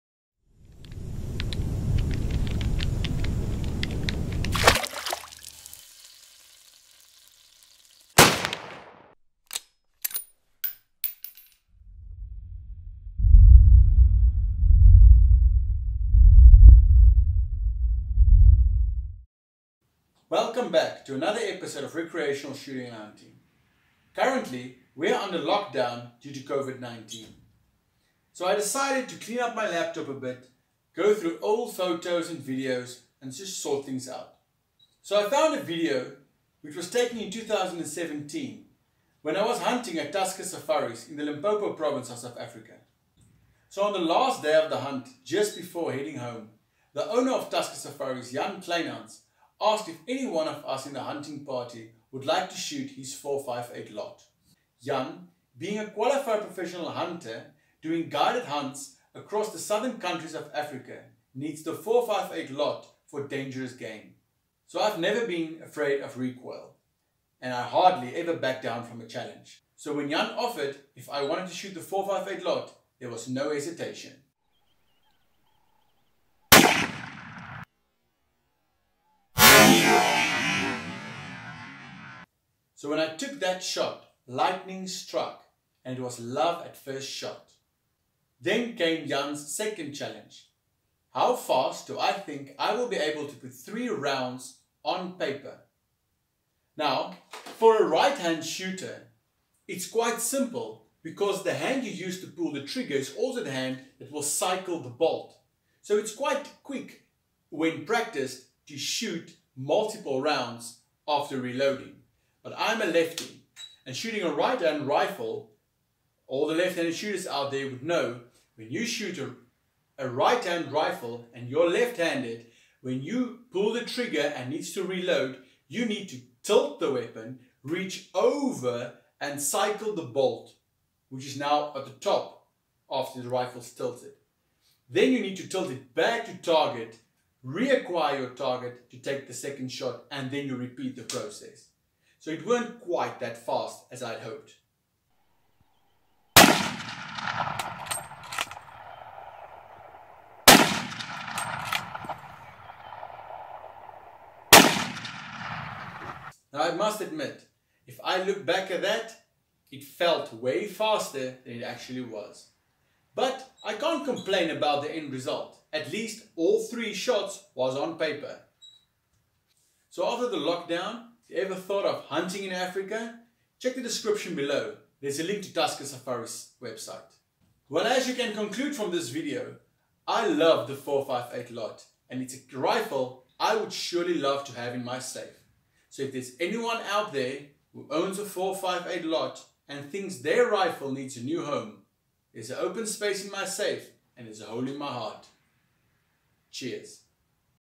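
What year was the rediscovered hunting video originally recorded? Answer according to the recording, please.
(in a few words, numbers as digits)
2017.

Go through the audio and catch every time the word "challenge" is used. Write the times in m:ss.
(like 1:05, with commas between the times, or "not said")
1:09, 1:29.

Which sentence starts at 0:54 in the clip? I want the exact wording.
Jan, being a qualified professional hunter, doing guided hunts across the southern countries of Africa, needs the 458 Lott for dangerous game.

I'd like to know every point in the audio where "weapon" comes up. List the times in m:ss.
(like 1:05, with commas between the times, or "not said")
2:06.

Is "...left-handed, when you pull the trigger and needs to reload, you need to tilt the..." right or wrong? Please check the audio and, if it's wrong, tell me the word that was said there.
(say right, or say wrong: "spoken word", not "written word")
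right.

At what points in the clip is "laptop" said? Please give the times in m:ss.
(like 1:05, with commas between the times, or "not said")
0:29.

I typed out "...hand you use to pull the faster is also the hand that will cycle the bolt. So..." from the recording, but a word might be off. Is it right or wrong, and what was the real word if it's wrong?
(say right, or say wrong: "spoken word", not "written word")
wrong: "trigger", not "faster".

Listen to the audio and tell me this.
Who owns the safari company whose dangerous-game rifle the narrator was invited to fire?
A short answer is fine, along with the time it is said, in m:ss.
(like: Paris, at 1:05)
Jan Kleinhans, at 0:48.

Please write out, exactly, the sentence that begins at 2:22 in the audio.
So it weren't quite that fast as I'd hoped.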